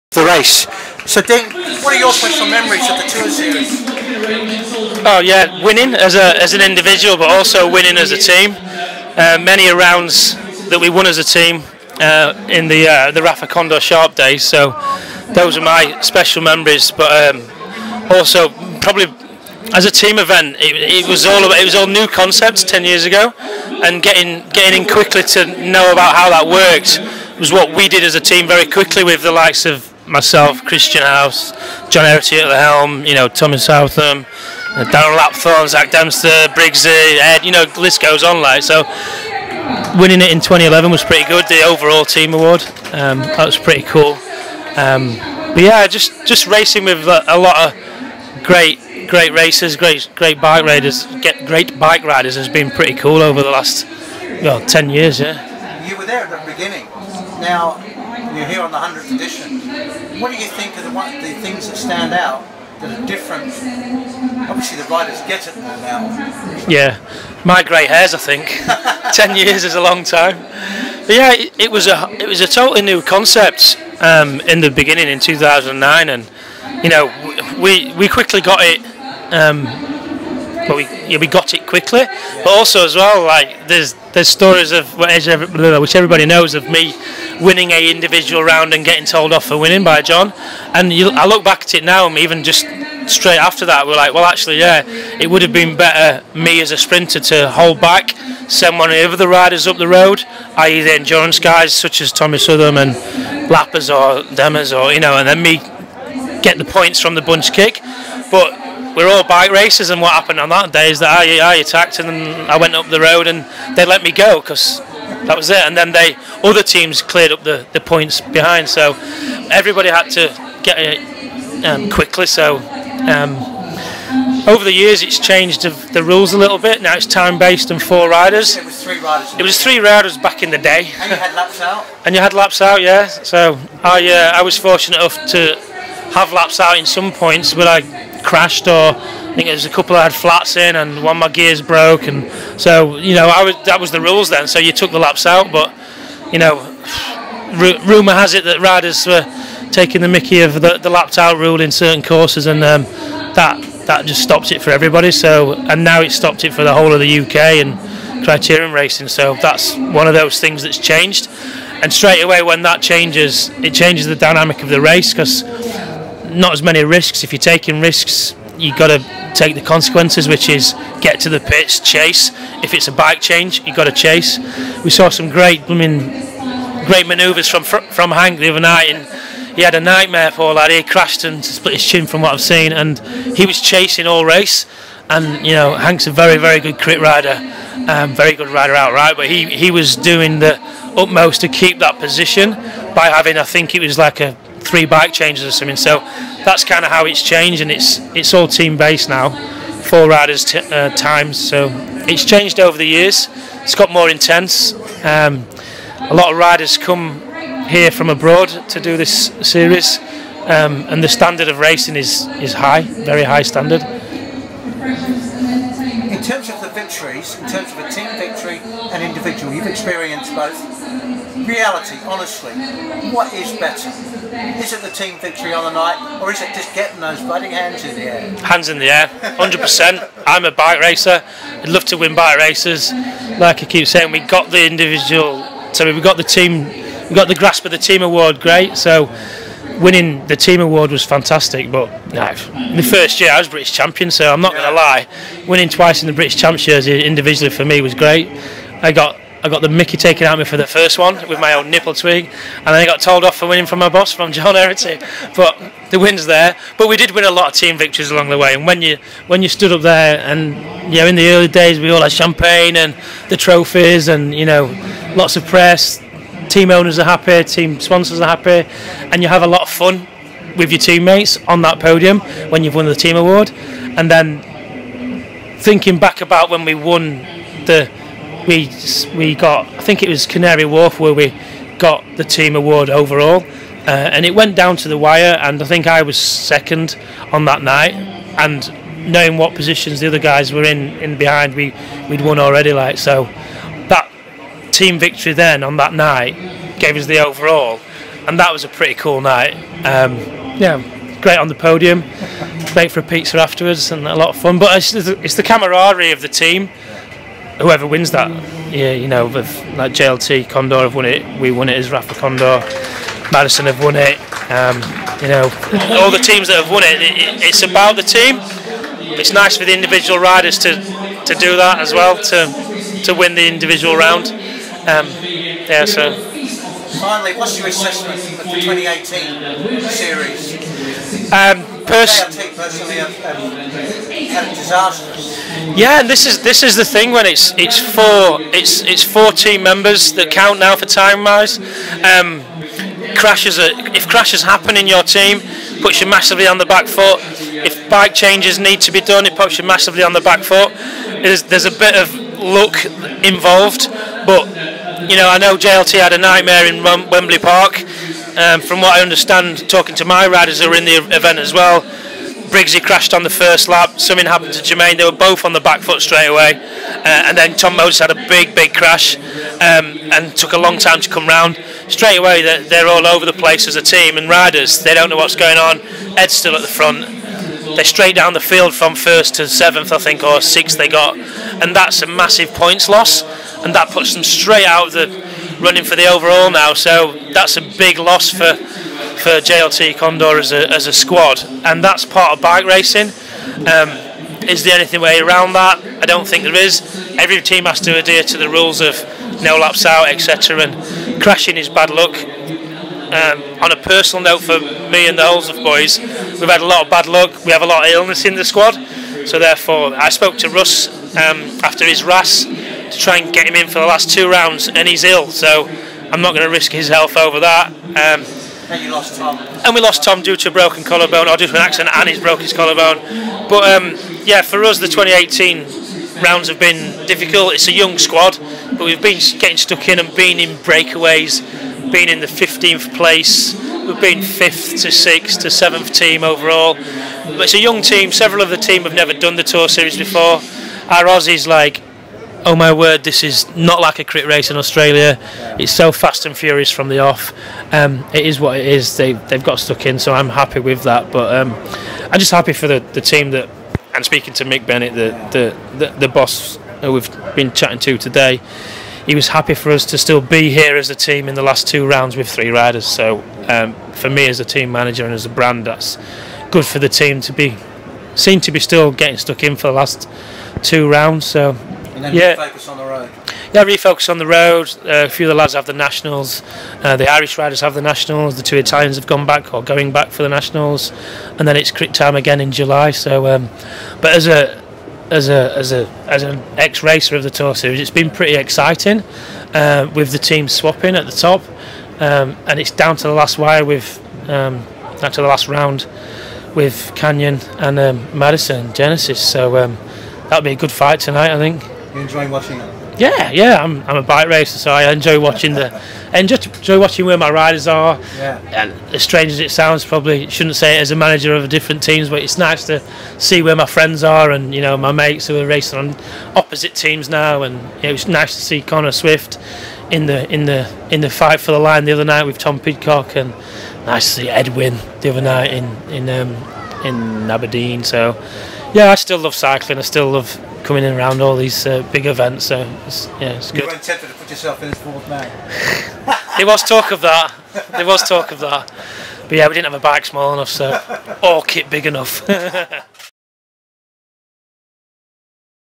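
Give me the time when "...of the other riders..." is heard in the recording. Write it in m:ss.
1:38.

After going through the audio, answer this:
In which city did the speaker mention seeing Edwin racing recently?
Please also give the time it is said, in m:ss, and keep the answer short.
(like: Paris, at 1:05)
Aberdeen, at 8:47.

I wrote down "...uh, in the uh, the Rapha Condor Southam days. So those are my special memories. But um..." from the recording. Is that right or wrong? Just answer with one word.
wrong.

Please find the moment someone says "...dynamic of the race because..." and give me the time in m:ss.
2:44.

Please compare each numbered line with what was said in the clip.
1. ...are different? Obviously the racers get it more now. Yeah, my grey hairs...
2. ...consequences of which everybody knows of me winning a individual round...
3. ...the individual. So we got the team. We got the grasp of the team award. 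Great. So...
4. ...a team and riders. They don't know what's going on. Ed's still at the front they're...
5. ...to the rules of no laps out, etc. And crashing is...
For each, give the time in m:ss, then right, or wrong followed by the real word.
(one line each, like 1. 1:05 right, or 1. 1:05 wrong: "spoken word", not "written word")
1. 1:02 wrong: "riders", not "racers"
2. 1:24 wrong: "stories", not "consequences"
3. 3:54 right
4. 6:13 right
5. 6:38 right.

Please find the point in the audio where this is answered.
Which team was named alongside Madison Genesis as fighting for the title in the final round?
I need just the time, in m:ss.
8:16.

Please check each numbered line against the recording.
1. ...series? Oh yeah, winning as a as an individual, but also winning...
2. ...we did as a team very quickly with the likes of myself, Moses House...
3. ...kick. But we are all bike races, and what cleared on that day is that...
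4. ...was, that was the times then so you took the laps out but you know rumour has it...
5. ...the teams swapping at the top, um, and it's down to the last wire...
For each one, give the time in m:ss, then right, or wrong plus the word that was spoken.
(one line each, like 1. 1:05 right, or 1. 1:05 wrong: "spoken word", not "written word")
1. 0:03 right
2. 0:27 wrong: "Kristian", not "Moses"
3. 1:47 wrong: "happened", not "cleared"
4. 2:23 wrong: "rules", not "times"
5. 8:10 right.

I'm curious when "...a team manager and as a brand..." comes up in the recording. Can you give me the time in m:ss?
7:44.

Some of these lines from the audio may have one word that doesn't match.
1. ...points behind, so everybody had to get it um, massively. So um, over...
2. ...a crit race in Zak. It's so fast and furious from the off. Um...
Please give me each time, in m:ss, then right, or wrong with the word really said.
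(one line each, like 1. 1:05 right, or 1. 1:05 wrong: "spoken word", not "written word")
1. 1:57 wrong: "quickly", not "massively"
2. 7:23 wrong: "Australia", not "Zak".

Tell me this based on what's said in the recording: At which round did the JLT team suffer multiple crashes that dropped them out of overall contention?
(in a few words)
Wembley Park.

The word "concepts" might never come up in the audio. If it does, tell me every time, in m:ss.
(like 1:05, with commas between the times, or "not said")
0:22, 1:13.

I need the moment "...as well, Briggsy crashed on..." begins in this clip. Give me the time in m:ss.
6:01.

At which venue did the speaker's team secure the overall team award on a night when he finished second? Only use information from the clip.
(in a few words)
Canary Wharf.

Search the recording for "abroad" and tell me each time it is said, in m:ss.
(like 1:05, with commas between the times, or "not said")
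3:28.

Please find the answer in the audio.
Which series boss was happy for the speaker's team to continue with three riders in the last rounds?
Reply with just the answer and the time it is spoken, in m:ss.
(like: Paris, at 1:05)
Mick Bennett, at 7:34.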